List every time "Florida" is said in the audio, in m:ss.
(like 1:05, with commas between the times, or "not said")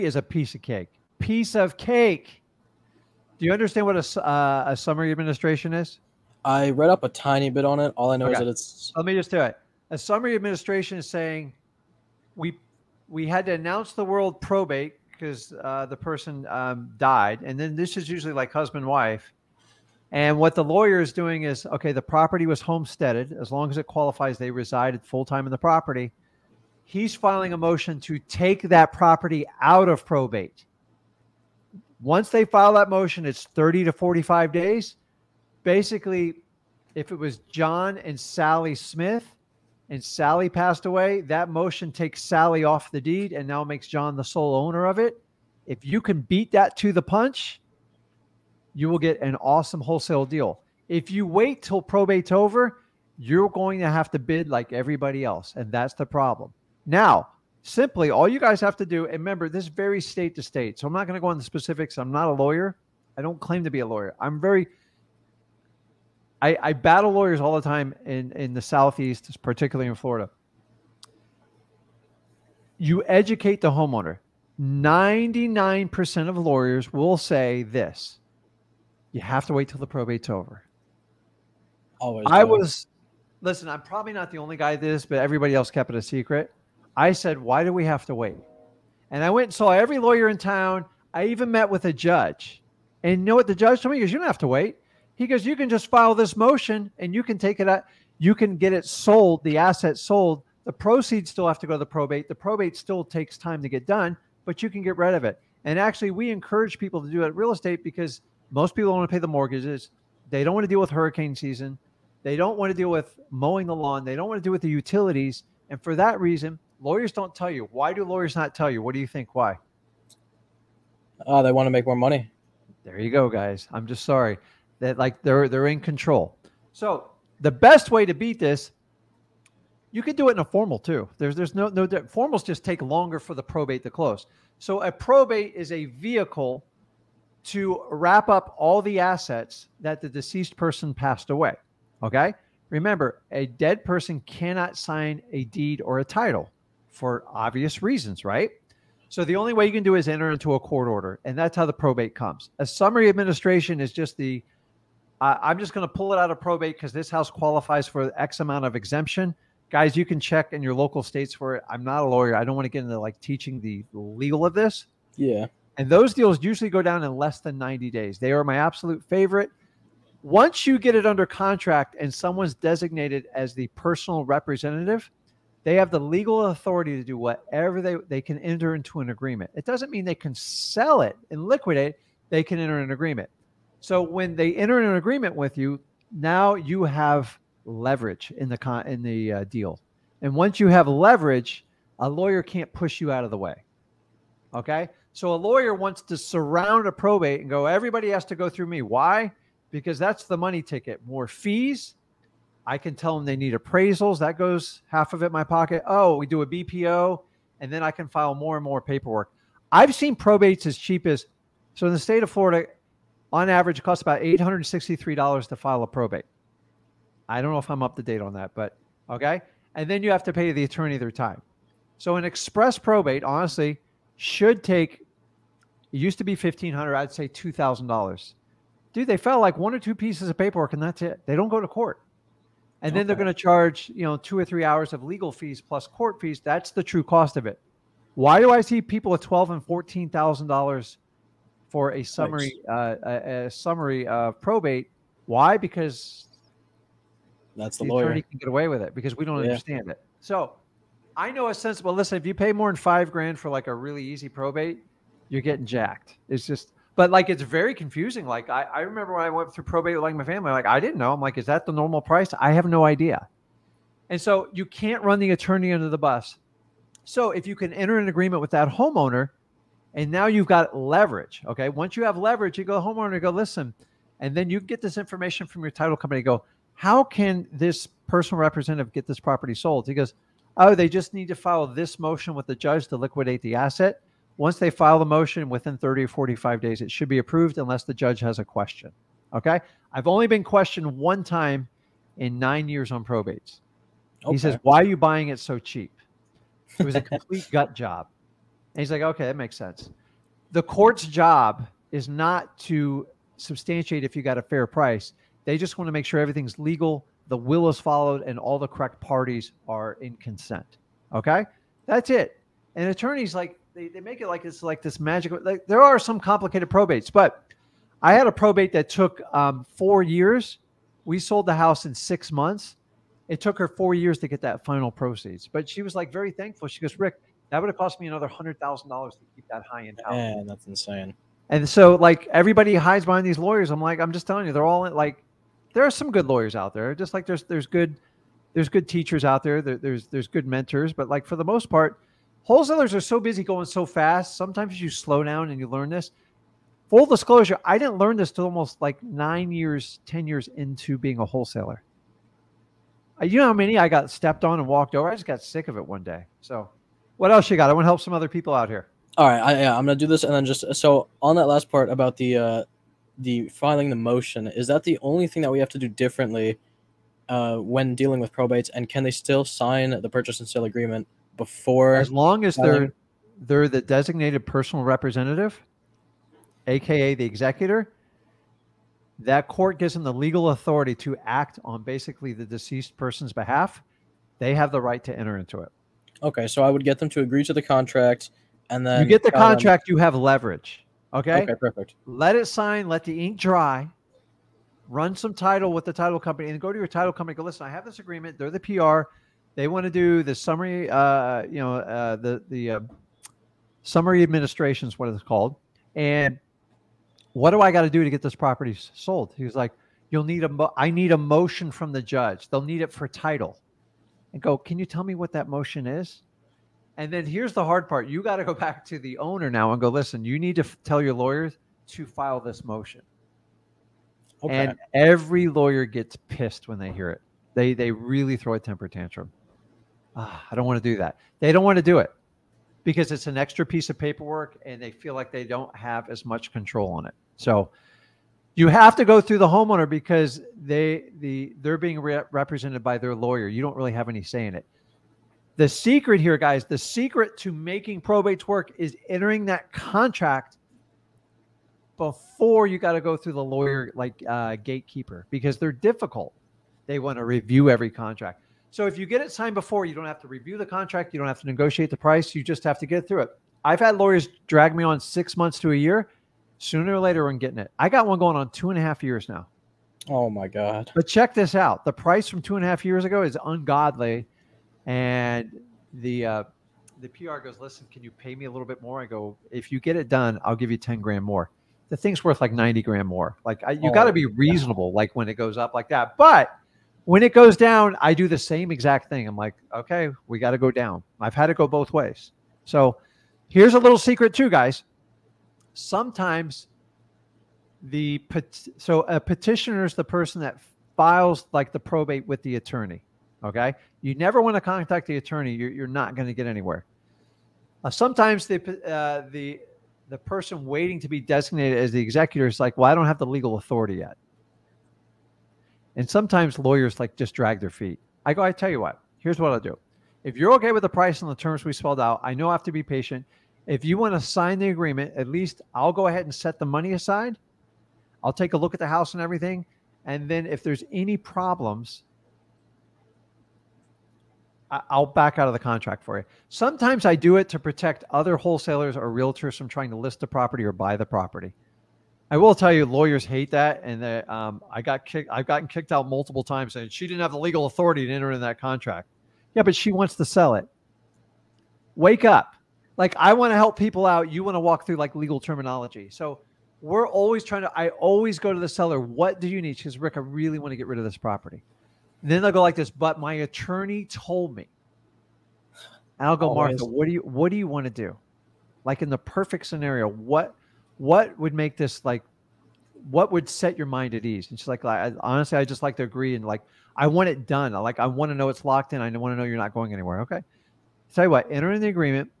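1:09, 3:32.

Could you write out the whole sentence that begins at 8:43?
If you want to sign the agreement, at least I'll go ahead and set the money aside.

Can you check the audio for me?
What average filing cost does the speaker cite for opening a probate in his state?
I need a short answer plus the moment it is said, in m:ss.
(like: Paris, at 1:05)
$863, at 3:34.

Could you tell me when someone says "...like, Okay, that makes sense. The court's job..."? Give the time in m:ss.
4:58.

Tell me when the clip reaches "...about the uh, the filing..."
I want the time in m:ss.
6:01.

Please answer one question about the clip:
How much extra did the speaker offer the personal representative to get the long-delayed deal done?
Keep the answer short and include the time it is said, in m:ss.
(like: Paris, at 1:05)
10 grand, at 8:00.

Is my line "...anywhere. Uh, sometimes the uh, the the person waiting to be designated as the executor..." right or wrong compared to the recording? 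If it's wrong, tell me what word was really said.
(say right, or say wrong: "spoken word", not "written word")
right.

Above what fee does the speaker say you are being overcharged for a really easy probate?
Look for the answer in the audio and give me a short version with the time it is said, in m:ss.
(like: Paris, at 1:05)
5 grand, at 4:12.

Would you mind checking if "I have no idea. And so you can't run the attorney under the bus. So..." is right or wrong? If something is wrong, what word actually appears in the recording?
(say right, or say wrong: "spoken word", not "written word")
right.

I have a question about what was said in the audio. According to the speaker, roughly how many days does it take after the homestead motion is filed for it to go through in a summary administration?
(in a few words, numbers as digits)
30 to 45 days.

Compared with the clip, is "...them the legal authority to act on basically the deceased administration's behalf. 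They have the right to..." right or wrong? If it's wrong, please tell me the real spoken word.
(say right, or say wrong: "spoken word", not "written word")
wrong: "person", not "administration".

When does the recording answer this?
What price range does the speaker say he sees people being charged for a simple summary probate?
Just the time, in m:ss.
3:59.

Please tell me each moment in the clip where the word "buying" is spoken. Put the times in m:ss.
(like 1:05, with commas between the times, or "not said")
4:54.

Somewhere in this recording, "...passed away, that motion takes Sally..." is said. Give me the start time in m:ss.
0:40.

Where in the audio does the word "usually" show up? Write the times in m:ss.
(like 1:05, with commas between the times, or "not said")
0:18, 2:46.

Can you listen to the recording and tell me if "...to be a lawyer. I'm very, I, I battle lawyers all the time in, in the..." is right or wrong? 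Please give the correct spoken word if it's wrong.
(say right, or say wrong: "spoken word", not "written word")
right.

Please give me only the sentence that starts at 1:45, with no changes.
And actually, we encourage people to do it real estate because – most people don't want to pay the mortgages.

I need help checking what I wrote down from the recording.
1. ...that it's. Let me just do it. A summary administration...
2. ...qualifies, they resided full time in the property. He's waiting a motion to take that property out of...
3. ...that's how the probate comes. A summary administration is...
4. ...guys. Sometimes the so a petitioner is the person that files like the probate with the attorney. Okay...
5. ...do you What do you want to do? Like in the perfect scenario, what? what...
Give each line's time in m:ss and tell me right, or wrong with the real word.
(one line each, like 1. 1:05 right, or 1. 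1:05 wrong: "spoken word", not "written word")
1. 0:08 right
2. 0:23 wrong: "filing", not "waiting"
3. 2:31 right
4. 8:14 right
5. 9:27 right.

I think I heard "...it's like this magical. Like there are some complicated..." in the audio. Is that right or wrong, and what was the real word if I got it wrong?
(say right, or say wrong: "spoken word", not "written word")
right.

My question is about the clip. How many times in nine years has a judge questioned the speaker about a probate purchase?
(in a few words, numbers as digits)
1.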